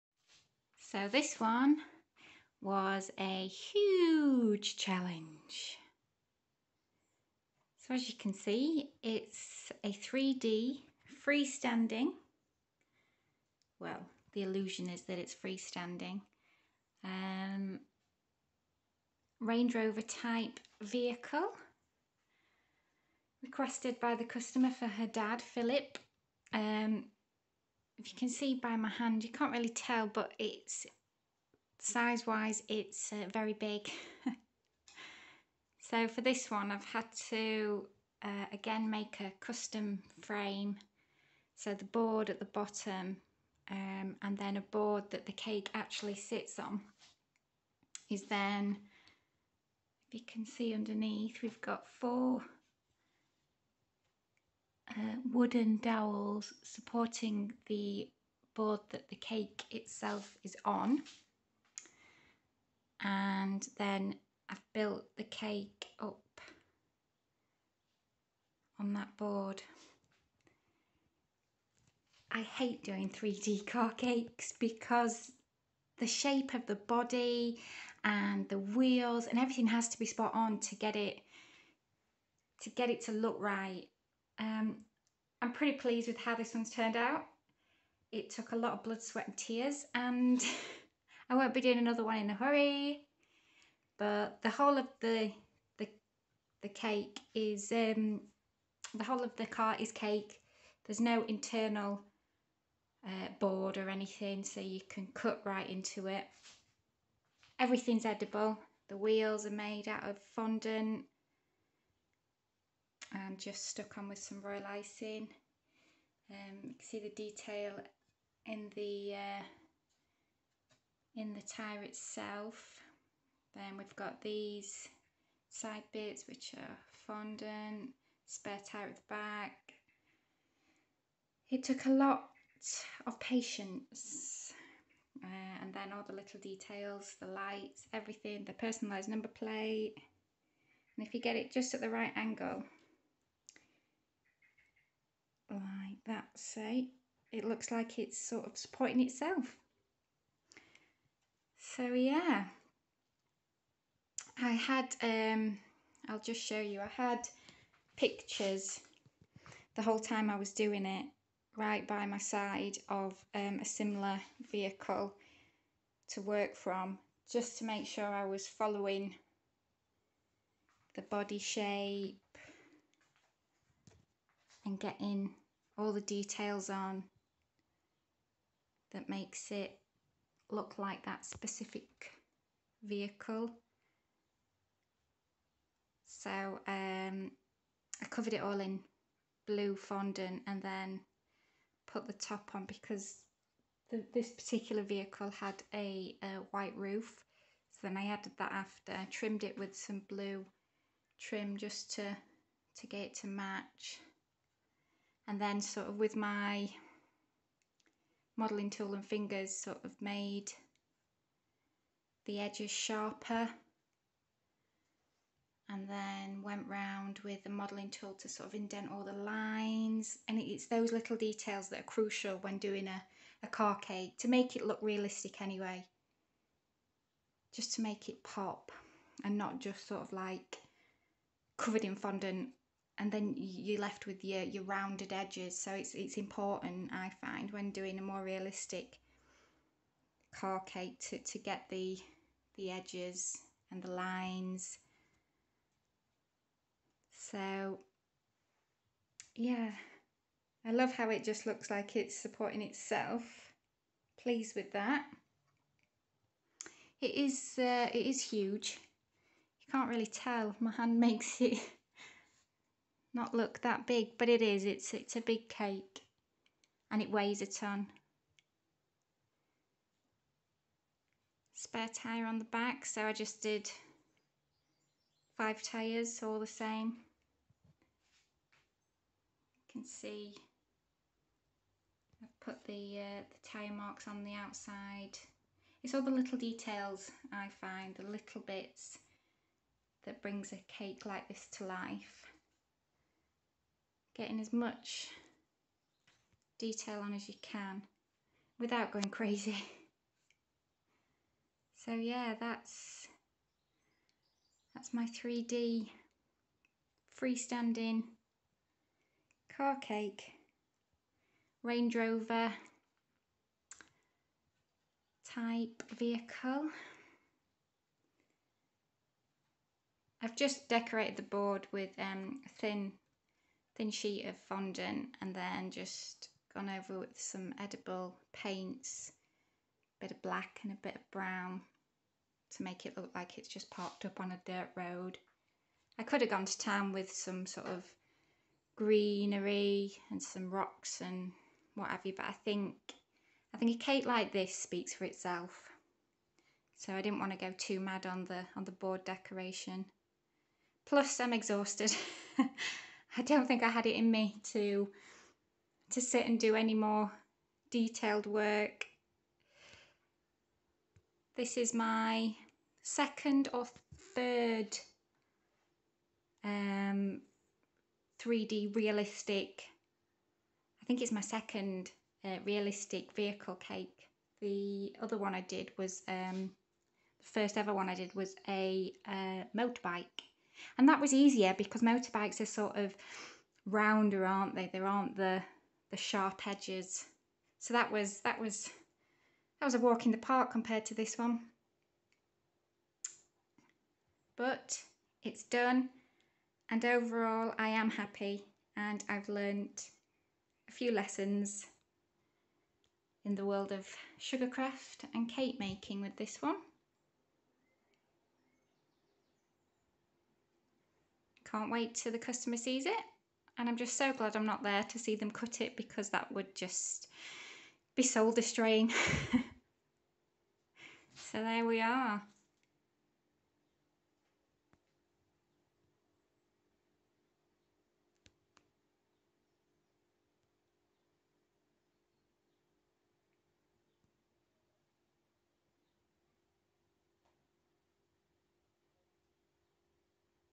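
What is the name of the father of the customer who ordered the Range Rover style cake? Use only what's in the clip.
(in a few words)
Philip.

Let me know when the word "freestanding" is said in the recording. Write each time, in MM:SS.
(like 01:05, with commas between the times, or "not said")
00:11, 00:15, 05:07.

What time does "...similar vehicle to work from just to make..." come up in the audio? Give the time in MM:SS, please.
02:43.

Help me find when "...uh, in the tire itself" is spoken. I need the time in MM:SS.
01:59.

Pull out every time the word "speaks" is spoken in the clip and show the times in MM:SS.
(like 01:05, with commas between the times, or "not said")
05:44.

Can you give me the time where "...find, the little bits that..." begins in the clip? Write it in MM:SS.
04:47.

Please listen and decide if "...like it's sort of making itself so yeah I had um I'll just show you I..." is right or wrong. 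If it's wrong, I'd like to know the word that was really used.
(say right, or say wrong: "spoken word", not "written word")
wrong: "supporting", not "making".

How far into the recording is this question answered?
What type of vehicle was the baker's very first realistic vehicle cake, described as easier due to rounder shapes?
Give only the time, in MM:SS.
06:19.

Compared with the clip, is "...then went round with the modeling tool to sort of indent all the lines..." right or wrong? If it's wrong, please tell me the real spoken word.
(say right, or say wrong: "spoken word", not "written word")
right.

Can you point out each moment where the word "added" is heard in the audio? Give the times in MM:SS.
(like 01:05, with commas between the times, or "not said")
03:18.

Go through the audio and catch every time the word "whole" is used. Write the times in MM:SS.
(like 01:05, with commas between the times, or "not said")
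01:34, 01:39, 02:39.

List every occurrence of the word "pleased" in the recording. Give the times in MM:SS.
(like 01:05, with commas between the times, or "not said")
01:25, 04:14.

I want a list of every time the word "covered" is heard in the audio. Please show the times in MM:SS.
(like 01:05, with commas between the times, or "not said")
03:08, 03:51.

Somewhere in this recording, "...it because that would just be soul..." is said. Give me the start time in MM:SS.
06:55.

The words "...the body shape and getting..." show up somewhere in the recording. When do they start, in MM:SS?
02:50.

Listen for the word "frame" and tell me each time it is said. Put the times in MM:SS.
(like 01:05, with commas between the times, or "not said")
00:40.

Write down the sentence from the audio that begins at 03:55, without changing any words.
So it's, it's important, I find, when doing a more realistic car cake to, to get the, the edges and the lines.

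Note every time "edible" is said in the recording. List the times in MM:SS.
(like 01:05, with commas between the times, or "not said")
01:48, 05:27.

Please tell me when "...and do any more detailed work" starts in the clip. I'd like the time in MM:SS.
05:56.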